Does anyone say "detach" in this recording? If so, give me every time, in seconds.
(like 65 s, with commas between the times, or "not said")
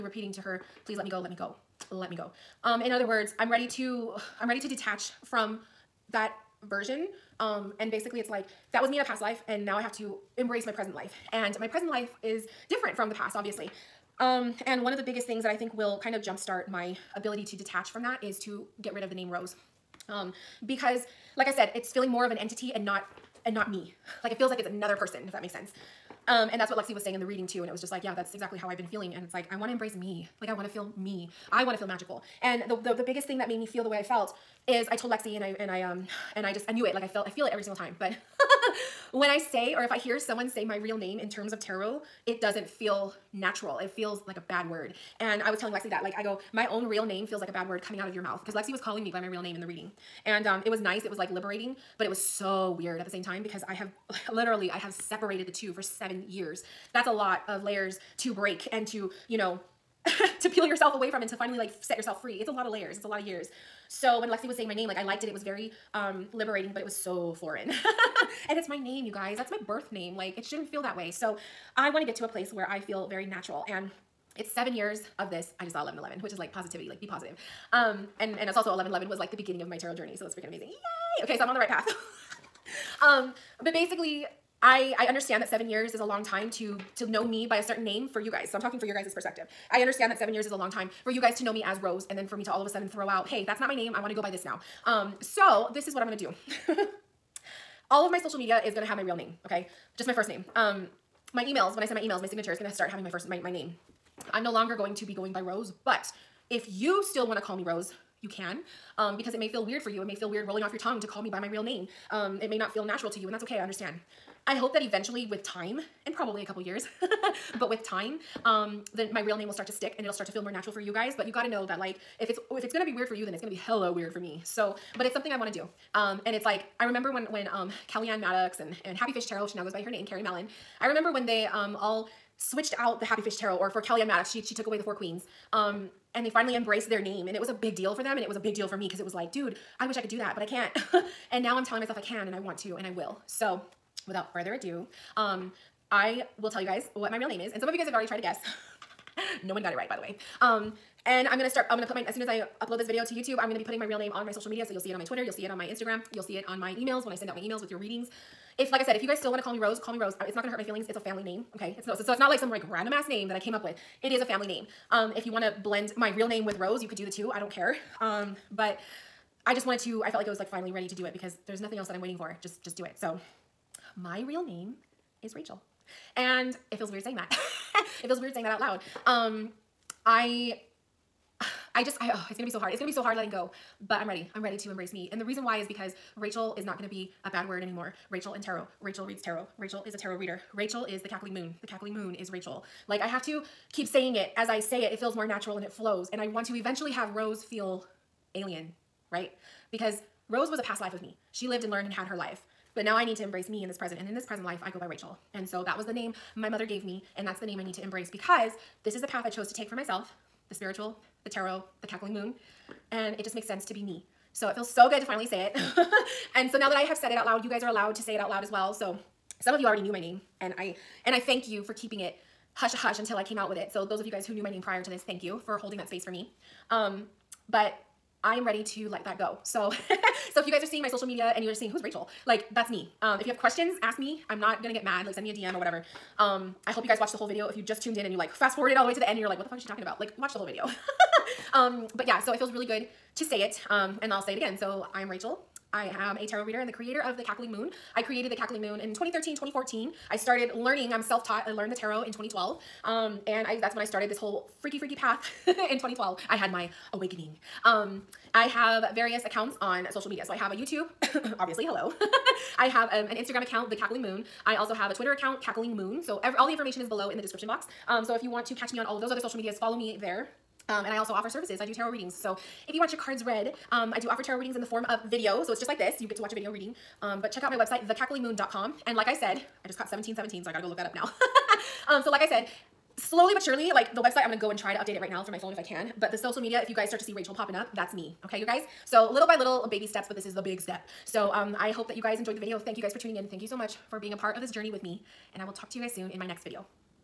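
4 s, 17 s.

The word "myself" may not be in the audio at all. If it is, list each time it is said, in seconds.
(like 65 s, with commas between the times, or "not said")
141 s, 209 s.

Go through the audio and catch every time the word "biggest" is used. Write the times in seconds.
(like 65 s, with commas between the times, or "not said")
15 s, 33 s.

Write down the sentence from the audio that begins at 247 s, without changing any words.
I created The Cackling Moon in 2013, 2014.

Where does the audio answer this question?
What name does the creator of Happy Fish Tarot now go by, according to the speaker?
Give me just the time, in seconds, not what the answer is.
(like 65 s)
130 s.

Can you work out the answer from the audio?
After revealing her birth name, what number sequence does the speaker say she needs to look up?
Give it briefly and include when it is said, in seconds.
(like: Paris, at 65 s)
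1717, at 279 s.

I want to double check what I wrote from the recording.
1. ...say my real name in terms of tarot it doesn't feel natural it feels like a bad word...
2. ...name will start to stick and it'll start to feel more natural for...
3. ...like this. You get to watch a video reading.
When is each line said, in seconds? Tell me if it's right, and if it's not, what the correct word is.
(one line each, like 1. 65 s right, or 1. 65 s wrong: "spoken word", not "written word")
1. 40 s right
2. 119 s right
3. 275 s right.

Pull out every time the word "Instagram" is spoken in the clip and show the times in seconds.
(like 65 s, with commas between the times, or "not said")
155 s, 263 s.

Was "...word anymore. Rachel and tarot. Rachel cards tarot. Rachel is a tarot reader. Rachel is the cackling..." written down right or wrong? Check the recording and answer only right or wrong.
wrong.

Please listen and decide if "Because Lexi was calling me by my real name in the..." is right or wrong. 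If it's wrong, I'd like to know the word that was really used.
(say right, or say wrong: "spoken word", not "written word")
right.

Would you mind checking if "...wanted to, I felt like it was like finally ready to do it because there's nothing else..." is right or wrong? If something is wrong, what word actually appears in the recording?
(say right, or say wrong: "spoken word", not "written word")
right.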